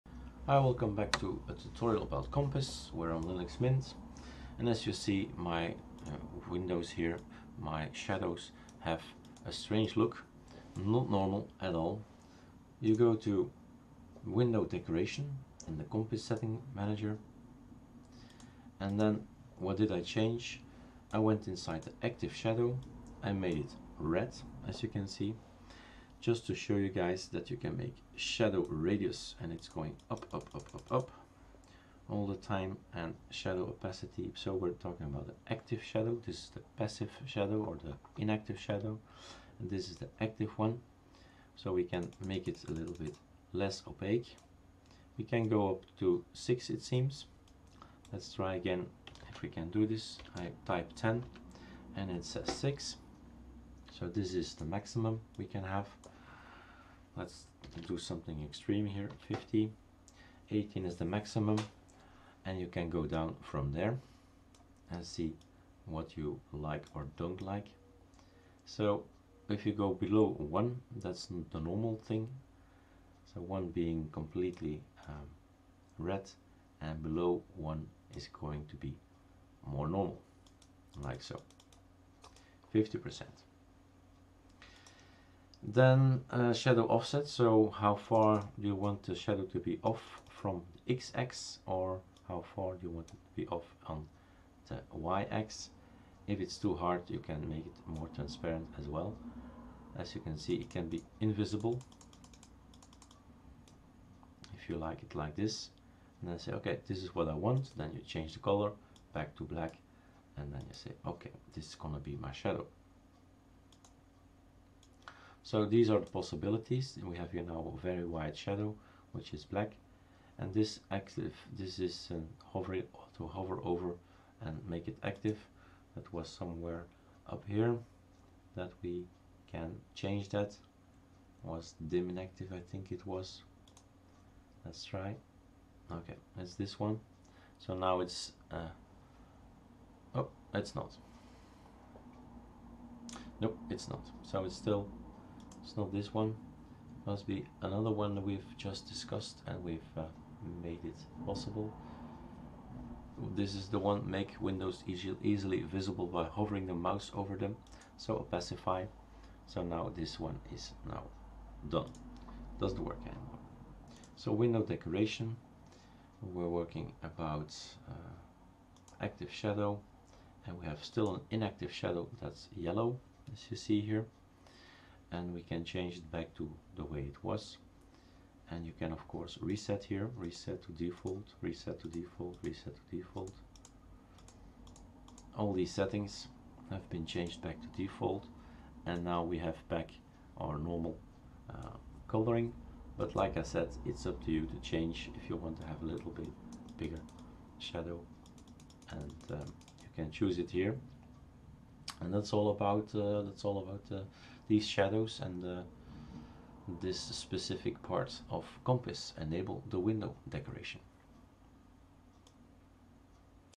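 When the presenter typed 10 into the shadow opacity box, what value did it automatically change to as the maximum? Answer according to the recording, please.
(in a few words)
6.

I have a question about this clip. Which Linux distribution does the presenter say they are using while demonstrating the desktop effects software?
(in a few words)
Linux Mint.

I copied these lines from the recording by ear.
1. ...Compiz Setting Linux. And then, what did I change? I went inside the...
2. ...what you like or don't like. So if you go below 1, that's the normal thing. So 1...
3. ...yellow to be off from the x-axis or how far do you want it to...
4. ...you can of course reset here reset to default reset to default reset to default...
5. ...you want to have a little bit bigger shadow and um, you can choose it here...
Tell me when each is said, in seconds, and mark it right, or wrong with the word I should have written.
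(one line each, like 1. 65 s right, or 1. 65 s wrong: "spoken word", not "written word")
1. 15 s wrong: "Manager", not "Linux"
2. 65 s right
3. 89 s wrong: "shadow", not "yellow"
4. 178 s right
5. 195 s right.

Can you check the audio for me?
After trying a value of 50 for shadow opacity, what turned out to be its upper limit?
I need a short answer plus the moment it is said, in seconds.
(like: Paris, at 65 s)
18, at 60 s.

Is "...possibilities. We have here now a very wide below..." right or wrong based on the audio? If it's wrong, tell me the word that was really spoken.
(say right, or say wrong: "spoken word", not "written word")
wrong: "shadow", not "below".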